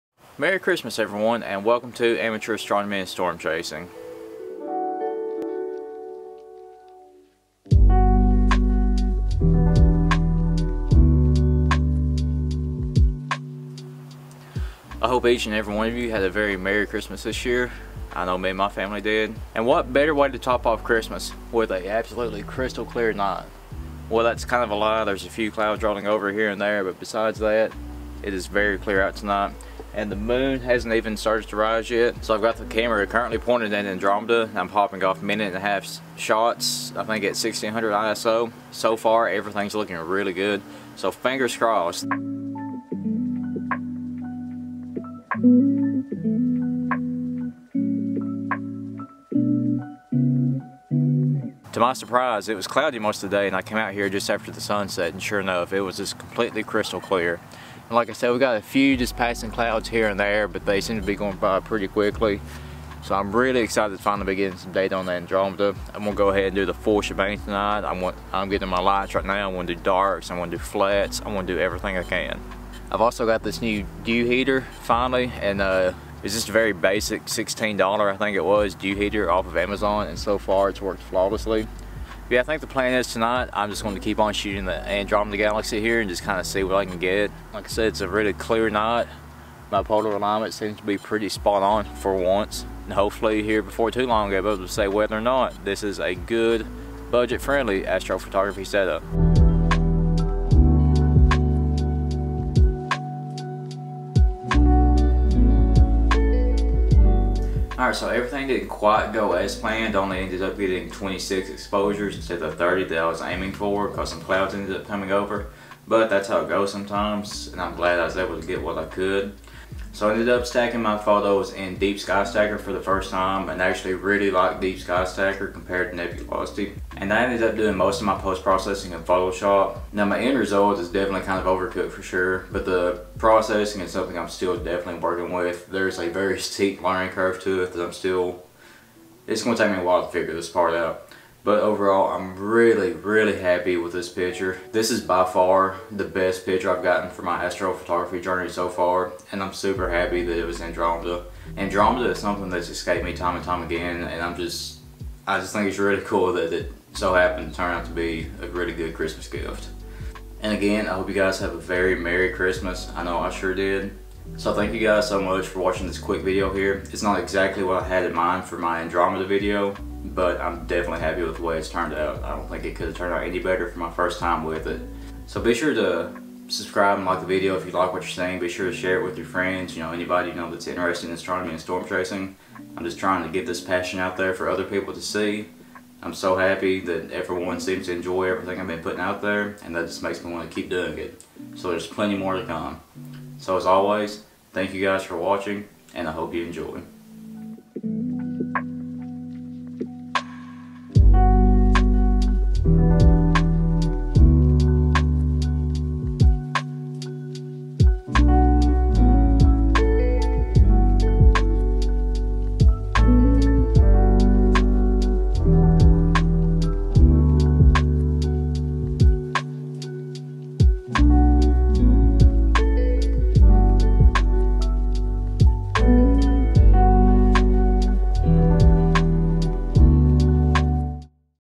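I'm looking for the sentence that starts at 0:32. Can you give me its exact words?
So I've got the camera currently pointed at Andromeda.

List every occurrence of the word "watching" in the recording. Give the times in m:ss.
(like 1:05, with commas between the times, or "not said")
2:45, 3:15.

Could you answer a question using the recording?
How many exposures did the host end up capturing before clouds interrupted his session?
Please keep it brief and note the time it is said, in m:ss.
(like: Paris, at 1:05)
26, at 1:50.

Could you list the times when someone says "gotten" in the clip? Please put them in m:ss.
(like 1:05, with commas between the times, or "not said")
2:26.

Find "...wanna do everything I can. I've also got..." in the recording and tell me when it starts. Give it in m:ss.
1:11.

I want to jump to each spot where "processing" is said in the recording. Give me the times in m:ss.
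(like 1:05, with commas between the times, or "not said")
2:08, 2:13.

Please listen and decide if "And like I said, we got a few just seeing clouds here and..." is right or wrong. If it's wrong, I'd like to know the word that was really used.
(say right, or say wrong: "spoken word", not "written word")
wrong: "passing", not "seeing".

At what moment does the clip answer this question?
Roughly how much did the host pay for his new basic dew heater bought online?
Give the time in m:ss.
1:17.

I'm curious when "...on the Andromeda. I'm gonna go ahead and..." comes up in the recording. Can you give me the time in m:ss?
1:04.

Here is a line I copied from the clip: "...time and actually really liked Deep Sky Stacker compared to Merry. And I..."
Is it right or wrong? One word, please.
wrong.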